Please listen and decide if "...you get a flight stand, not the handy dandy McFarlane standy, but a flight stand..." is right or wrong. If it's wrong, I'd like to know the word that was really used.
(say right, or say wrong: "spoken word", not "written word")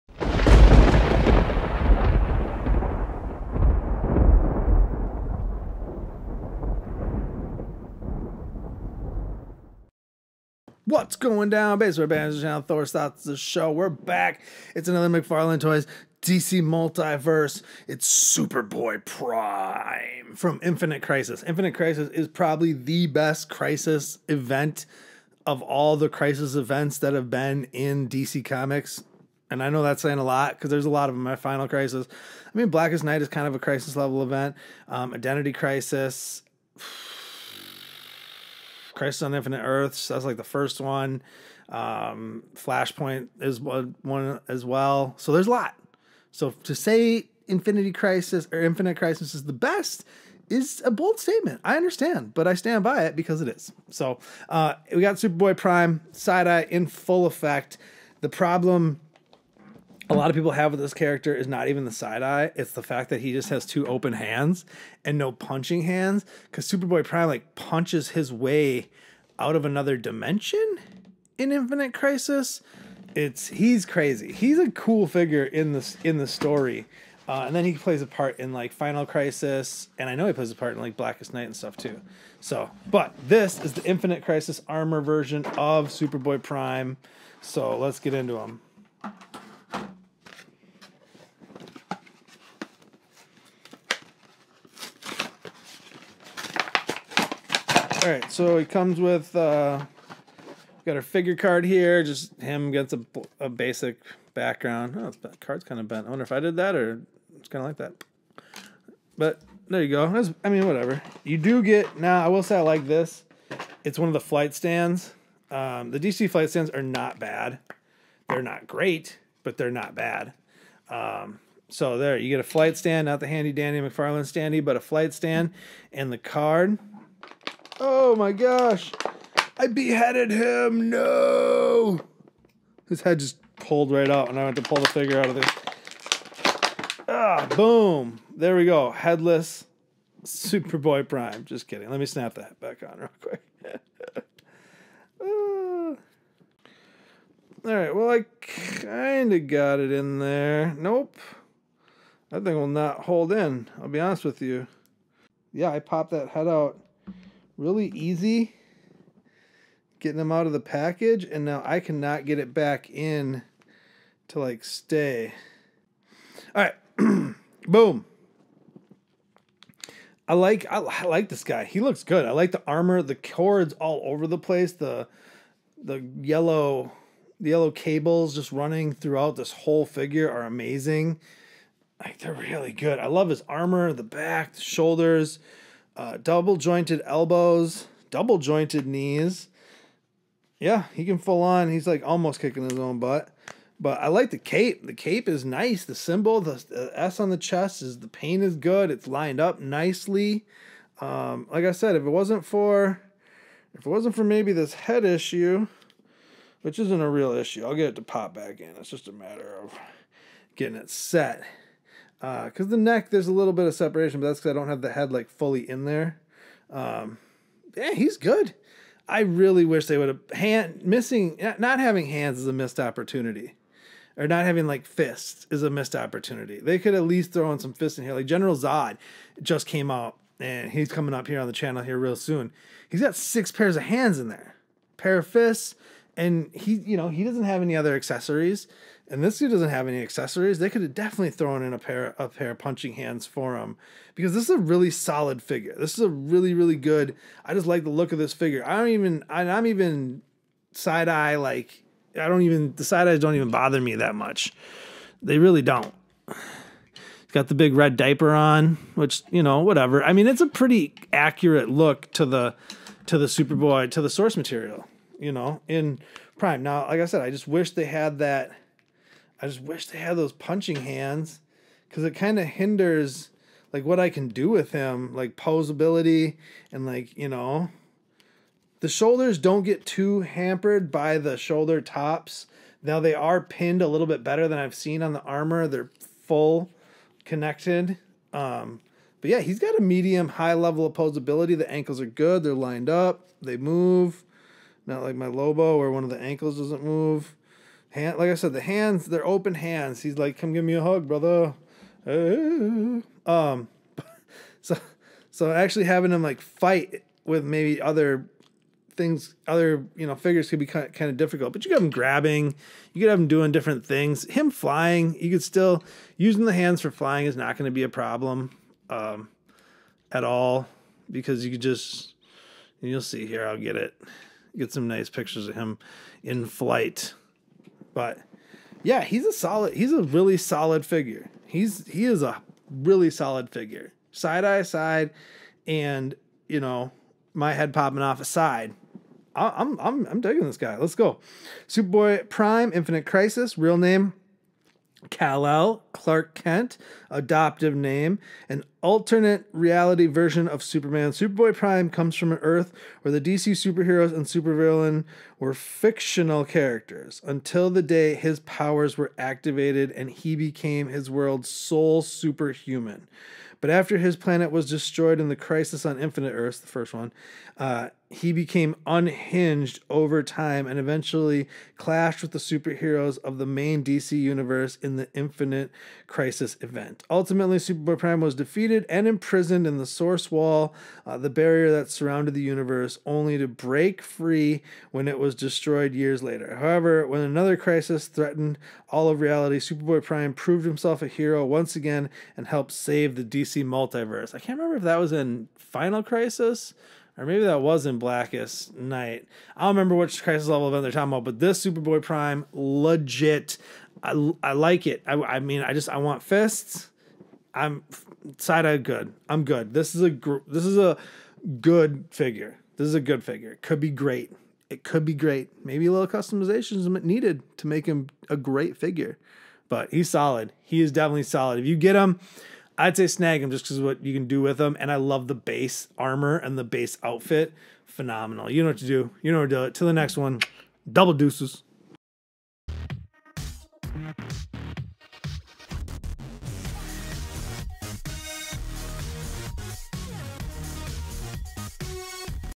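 right.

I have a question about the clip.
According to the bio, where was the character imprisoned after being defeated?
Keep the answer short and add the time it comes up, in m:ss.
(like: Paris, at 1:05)
The Source Wall, at 6:19.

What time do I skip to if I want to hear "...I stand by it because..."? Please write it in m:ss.
0:52.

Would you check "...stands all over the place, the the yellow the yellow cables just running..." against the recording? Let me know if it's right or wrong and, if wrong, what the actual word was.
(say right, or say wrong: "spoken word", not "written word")
wrong: "cords", not "stands".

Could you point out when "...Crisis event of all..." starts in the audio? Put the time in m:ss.
0:23.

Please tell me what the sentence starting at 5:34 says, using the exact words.
Side eye side, and you know my head popping off aside.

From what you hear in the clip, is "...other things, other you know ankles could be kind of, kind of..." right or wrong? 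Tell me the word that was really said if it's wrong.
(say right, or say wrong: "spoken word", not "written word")
wrong: "figures", not "ankles".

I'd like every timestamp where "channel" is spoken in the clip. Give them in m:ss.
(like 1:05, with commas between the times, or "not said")
0:12, 3:51.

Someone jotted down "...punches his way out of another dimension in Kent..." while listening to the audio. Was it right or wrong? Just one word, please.
wrong.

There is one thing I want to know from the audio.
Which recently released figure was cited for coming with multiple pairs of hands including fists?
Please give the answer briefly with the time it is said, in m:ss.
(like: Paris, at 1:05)
General Zod, at 3:48.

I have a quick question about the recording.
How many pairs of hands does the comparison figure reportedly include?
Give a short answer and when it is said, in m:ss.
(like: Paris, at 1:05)
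6, at 3:53.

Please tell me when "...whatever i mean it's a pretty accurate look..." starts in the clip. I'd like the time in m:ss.
4:19.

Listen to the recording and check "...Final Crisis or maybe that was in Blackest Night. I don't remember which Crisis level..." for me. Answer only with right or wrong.
right.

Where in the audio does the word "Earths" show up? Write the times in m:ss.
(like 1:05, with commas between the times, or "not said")
0:39, 5:52, 6:06.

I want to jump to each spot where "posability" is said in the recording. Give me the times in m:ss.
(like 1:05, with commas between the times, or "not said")
4:35, 4:50.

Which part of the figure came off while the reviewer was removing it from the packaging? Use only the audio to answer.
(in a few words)
His head.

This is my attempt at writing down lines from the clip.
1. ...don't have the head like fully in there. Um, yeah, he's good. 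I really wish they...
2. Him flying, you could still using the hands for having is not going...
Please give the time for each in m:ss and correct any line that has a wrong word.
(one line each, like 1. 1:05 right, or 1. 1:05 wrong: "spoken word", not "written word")
1. 3:34 right
2. 5:14 wrong: "flying", not "having".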